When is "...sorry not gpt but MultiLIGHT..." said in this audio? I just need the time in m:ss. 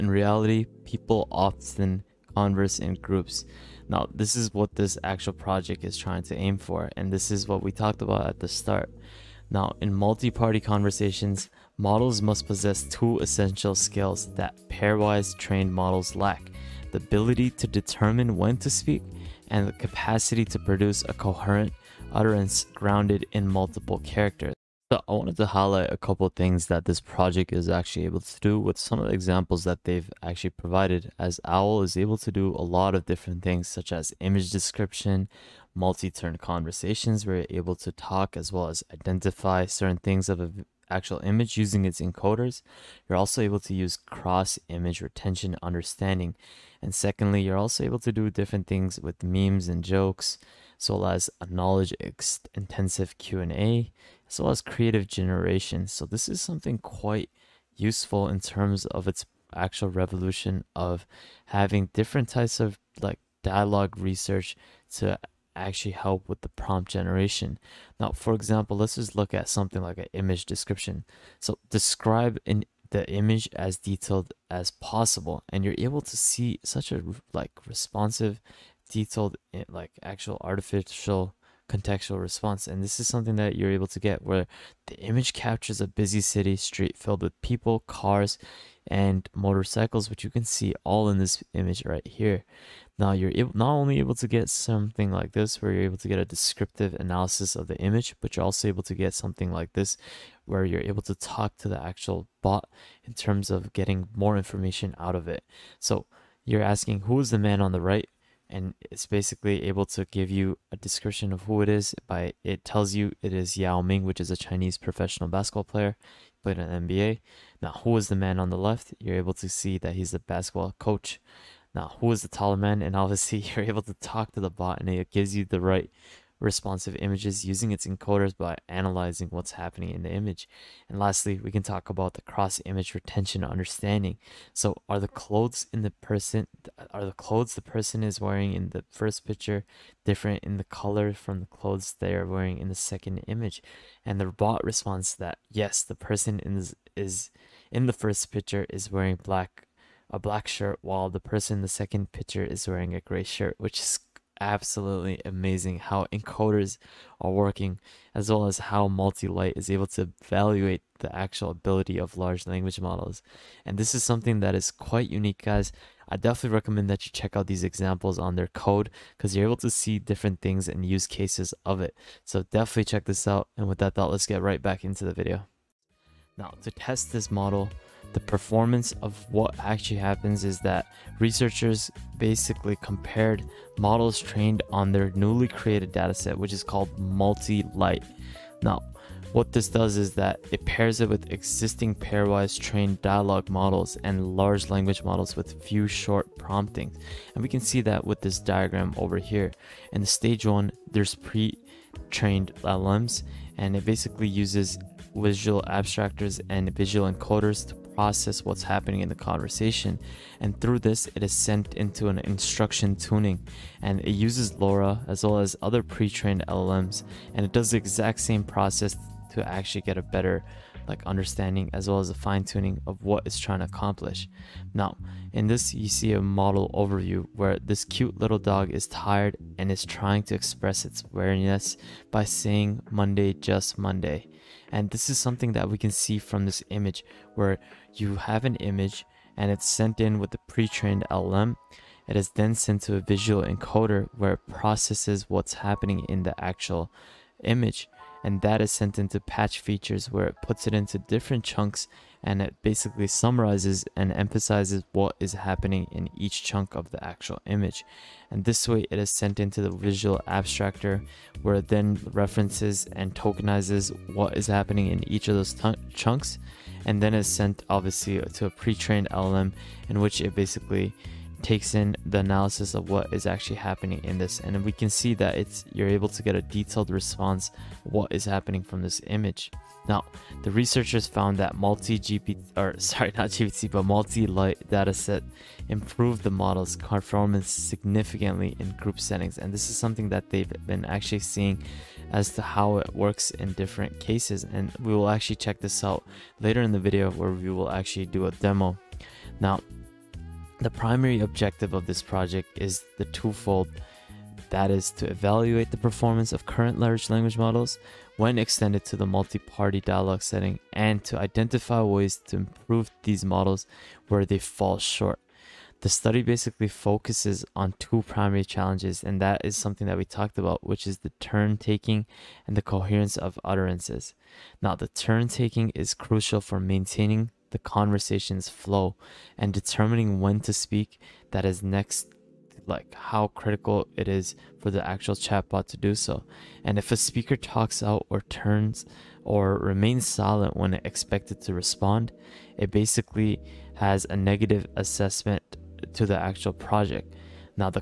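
4:42.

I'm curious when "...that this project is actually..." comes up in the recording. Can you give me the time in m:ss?
0:26.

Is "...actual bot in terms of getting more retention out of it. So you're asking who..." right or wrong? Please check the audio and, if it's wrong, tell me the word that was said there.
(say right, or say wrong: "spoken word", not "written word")
wrong: "information", not "retention".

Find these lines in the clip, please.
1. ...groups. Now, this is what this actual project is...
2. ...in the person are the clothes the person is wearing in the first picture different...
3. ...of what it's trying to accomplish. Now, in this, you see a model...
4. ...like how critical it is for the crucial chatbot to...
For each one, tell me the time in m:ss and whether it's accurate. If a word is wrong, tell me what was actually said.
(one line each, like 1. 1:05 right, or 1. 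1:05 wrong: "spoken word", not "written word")
1. 0:03 right
2. 2:15 right
3. 3:42 right
4. 5:32 wrong: "actual", not "crucial".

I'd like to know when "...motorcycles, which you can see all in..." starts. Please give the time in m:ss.
1:29.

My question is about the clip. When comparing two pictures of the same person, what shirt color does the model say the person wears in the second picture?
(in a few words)
Gray.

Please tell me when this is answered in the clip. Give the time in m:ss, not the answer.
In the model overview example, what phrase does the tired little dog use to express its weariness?
3:52.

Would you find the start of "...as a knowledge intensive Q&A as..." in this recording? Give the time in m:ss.
0:51.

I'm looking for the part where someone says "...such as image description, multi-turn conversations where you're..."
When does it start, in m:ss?
0:33.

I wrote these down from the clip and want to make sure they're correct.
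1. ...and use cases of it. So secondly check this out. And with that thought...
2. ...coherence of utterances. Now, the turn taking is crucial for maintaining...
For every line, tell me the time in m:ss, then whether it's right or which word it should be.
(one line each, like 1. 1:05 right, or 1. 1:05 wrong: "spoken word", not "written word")
1. 2:50 wrong: "definitely", not "secondly"
2. 5:22 right.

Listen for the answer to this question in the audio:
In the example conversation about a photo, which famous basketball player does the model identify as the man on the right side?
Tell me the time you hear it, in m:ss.
1:53.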